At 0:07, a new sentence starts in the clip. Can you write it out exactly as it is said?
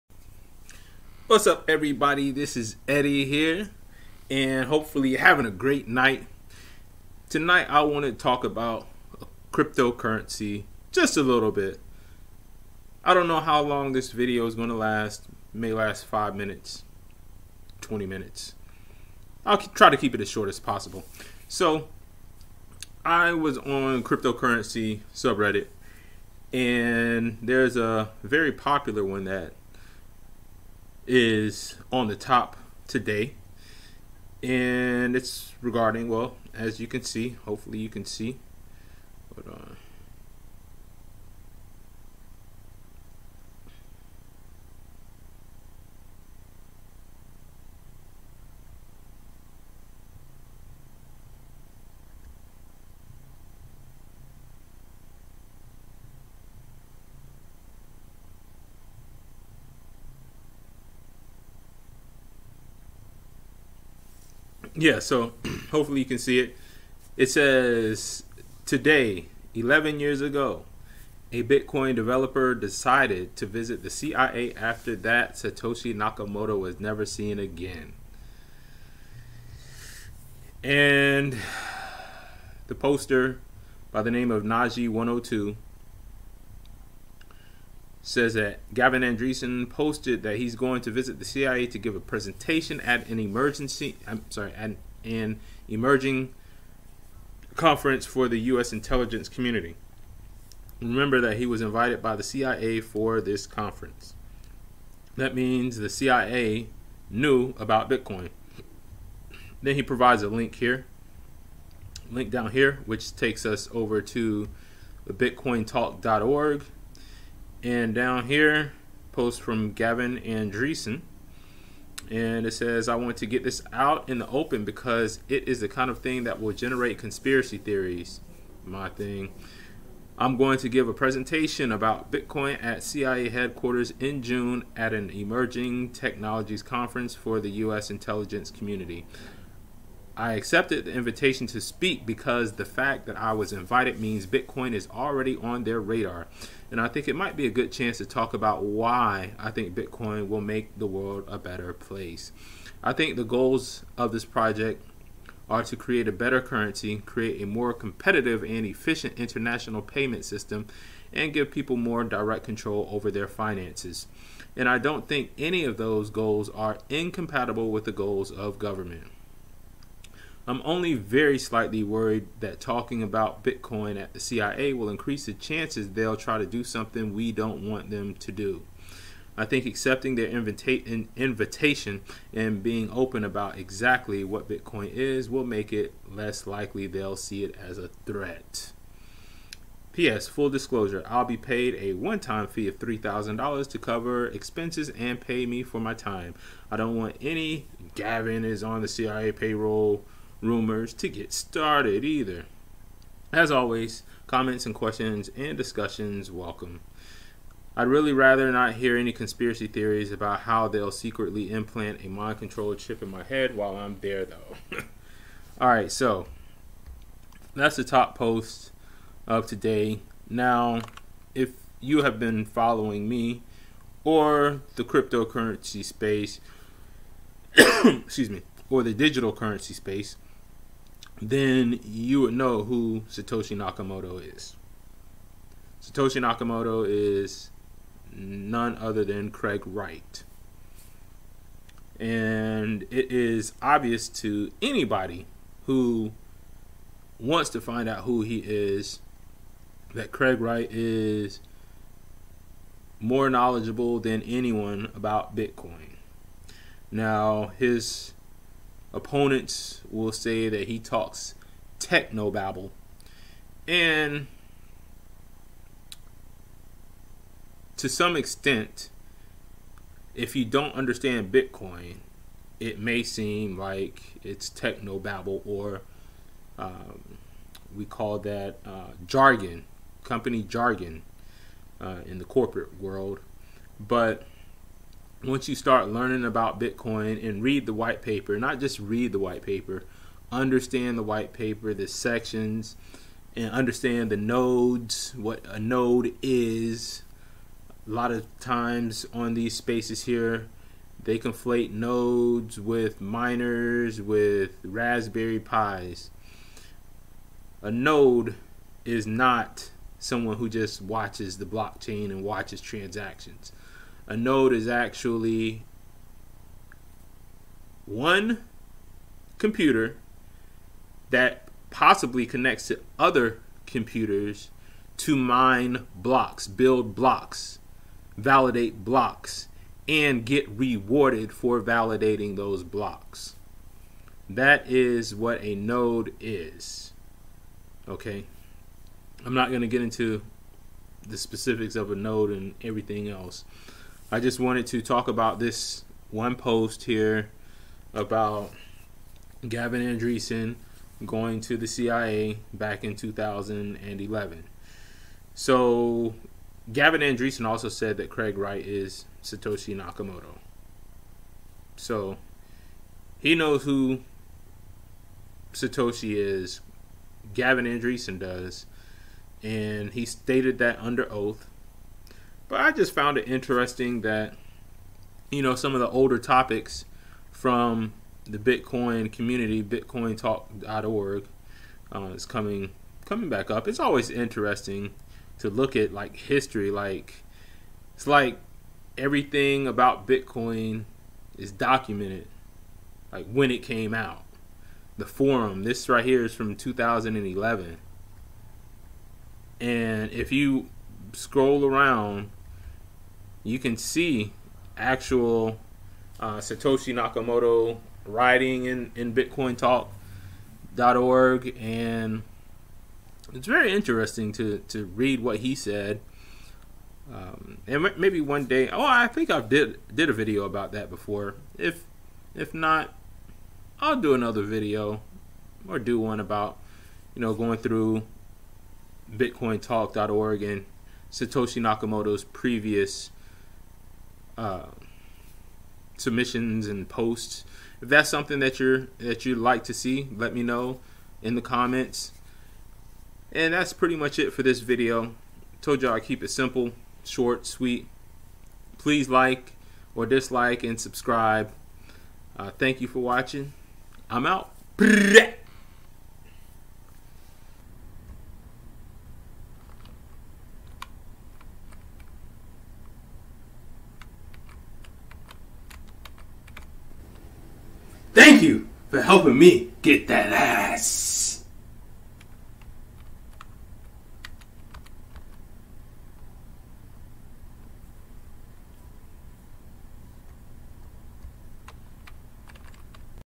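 Tonight, I want to talk about cryptocurrency just a little bit.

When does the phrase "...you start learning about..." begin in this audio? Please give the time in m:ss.
4:45.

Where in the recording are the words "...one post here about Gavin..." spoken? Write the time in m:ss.
5:46.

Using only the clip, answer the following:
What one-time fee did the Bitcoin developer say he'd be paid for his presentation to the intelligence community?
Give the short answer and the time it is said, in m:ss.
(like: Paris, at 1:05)
$3,000, at 3:12.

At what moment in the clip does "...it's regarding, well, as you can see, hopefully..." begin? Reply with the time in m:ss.
0:35.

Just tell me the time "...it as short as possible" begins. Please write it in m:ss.
0:20.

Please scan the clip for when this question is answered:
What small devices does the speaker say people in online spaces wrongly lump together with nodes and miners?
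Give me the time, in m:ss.
5:04.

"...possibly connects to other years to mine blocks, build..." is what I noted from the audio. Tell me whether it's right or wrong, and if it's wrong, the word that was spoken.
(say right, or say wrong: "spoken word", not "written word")
wrong: "computers", not "years".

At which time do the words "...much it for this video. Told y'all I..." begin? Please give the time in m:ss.
7:23.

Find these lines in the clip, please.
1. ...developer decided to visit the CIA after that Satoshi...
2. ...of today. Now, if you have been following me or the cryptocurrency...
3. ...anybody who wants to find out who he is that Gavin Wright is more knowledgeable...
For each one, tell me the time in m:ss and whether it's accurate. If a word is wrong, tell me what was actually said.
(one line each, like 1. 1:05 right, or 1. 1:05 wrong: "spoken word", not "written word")
1. 1:11 right
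2. 3:39 right
3. 4:04 wrong: "Craig", not "Gavin".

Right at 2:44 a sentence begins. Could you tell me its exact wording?
And I don't think any of those goals are incompatible with the goals of government.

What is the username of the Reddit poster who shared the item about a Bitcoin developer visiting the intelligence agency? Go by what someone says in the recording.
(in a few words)
Naji 102.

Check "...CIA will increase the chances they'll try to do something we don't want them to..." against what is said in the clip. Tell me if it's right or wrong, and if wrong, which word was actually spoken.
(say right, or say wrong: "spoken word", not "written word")
right.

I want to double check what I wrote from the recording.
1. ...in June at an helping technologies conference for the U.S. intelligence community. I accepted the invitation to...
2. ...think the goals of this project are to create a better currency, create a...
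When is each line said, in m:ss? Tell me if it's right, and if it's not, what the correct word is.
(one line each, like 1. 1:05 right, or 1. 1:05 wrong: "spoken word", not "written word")
1. 2:13 wrong: "emerging", not "helping"
2. 2:32 right.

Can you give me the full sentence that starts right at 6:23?
It's always interesting to look at like history.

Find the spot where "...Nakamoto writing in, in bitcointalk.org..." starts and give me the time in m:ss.
6:46.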